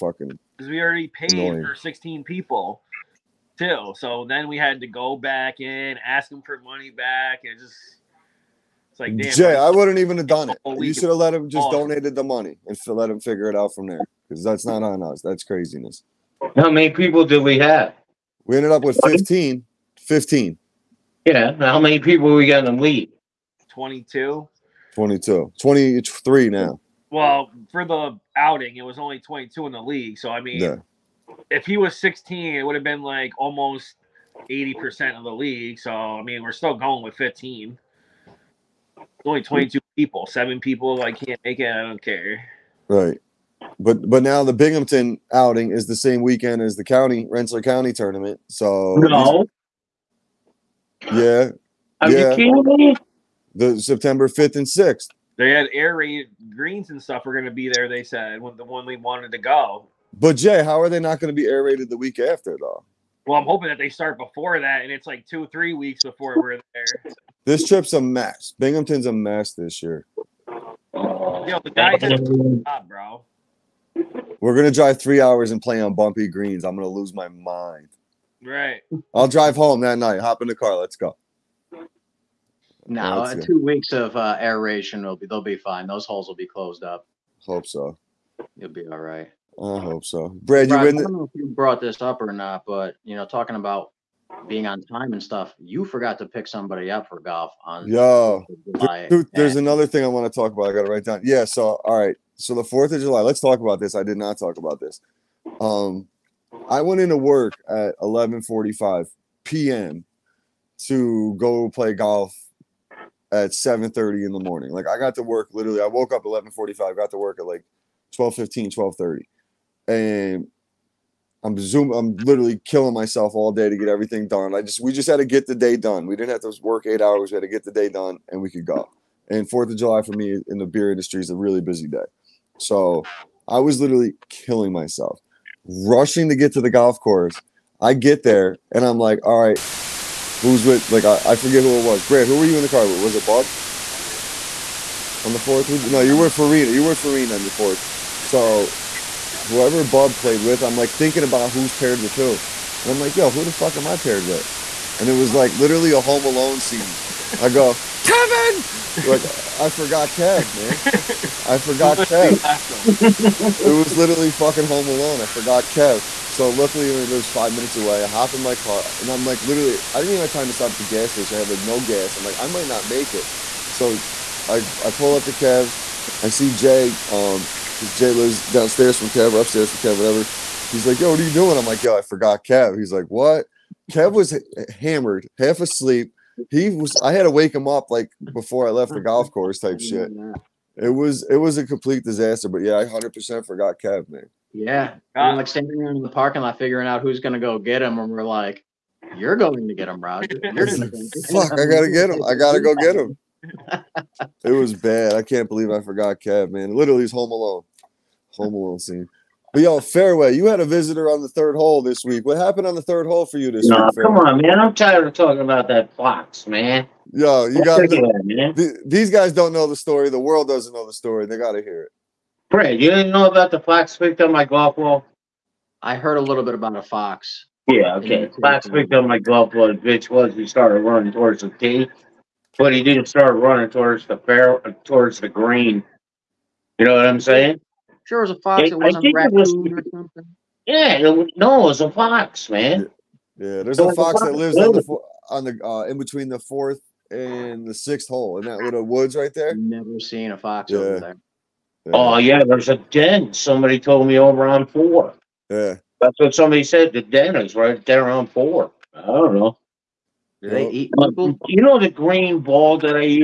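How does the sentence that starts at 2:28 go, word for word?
So whoever Bob played with, I'm like thinking about who's paired with who.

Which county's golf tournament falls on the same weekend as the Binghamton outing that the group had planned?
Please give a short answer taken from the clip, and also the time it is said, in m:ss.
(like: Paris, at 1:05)
Rensselaer County, at 0:47.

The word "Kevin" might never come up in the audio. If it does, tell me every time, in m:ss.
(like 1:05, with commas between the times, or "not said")
2:38.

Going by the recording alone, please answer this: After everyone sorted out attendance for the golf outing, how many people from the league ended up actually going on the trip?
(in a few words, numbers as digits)
15.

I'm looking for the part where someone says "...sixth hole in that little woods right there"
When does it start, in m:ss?
4:07.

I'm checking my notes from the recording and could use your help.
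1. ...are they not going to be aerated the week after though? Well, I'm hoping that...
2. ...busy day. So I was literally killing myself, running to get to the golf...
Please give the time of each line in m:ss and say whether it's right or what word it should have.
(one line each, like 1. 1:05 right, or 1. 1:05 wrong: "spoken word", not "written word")
1. 1:00 right
2. 2:11 wrong: "rushing", not "running".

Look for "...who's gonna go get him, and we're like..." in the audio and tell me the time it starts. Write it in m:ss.
3:17.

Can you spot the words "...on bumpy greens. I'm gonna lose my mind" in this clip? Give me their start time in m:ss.
1:15.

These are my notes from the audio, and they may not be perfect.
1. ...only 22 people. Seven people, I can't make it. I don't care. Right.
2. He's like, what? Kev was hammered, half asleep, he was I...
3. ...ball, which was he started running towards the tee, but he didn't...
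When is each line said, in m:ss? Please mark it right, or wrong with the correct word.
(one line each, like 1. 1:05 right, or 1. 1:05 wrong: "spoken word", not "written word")
1. 0:39 right
2. 3:02 right
3. 3:49 right.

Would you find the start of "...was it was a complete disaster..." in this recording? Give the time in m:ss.
3:10.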